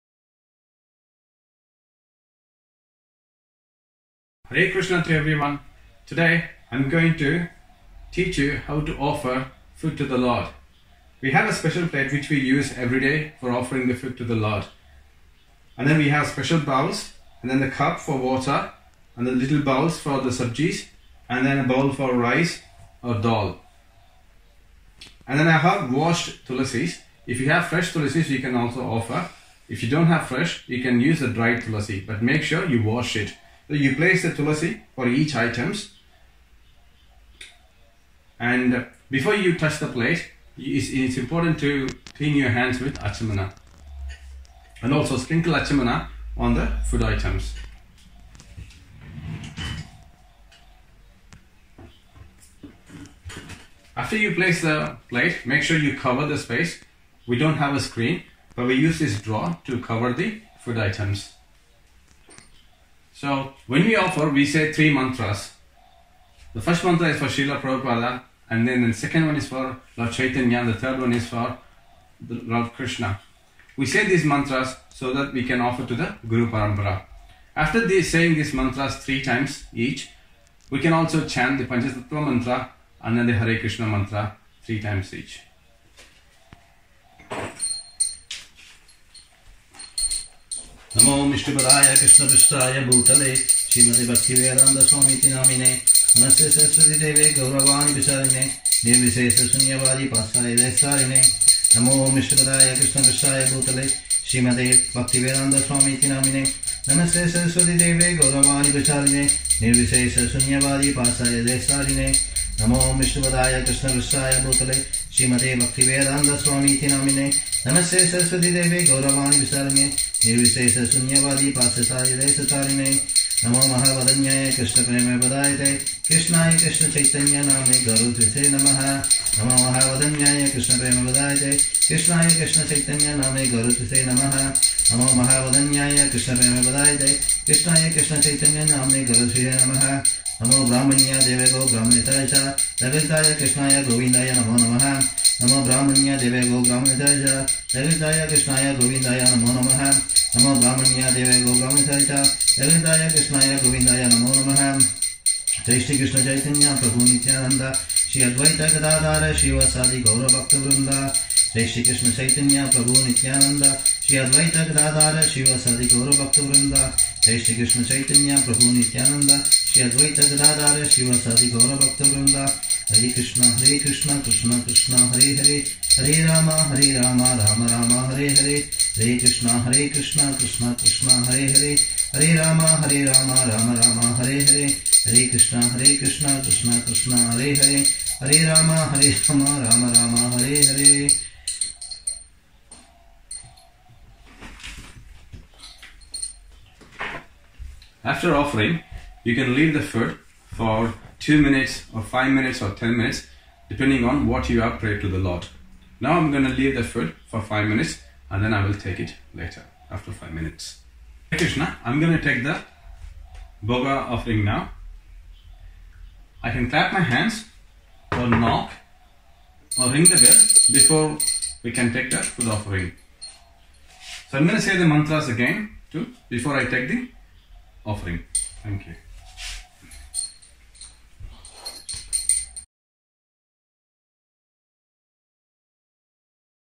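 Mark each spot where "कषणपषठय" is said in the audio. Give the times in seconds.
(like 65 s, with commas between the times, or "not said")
91 s, 102 s, 113 s.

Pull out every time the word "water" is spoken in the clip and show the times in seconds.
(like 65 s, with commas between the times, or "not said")
18 s.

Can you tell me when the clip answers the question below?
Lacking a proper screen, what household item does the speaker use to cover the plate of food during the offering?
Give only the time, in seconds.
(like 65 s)
59 s.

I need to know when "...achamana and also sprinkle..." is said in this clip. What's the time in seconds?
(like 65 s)
42 s.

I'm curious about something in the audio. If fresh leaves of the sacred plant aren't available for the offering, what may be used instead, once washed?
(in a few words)
Dried tulasi.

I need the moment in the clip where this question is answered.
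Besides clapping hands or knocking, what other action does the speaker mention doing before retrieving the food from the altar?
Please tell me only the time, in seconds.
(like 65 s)
219 s.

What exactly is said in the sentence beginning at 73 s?
We say these mantras so that we can offer to the Guru Parampara.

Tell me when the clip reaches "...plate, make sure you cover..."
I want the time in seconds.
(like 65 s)
55 s.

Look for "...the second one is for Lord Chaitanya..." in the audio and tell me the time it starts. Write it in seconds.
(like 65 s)
68 s.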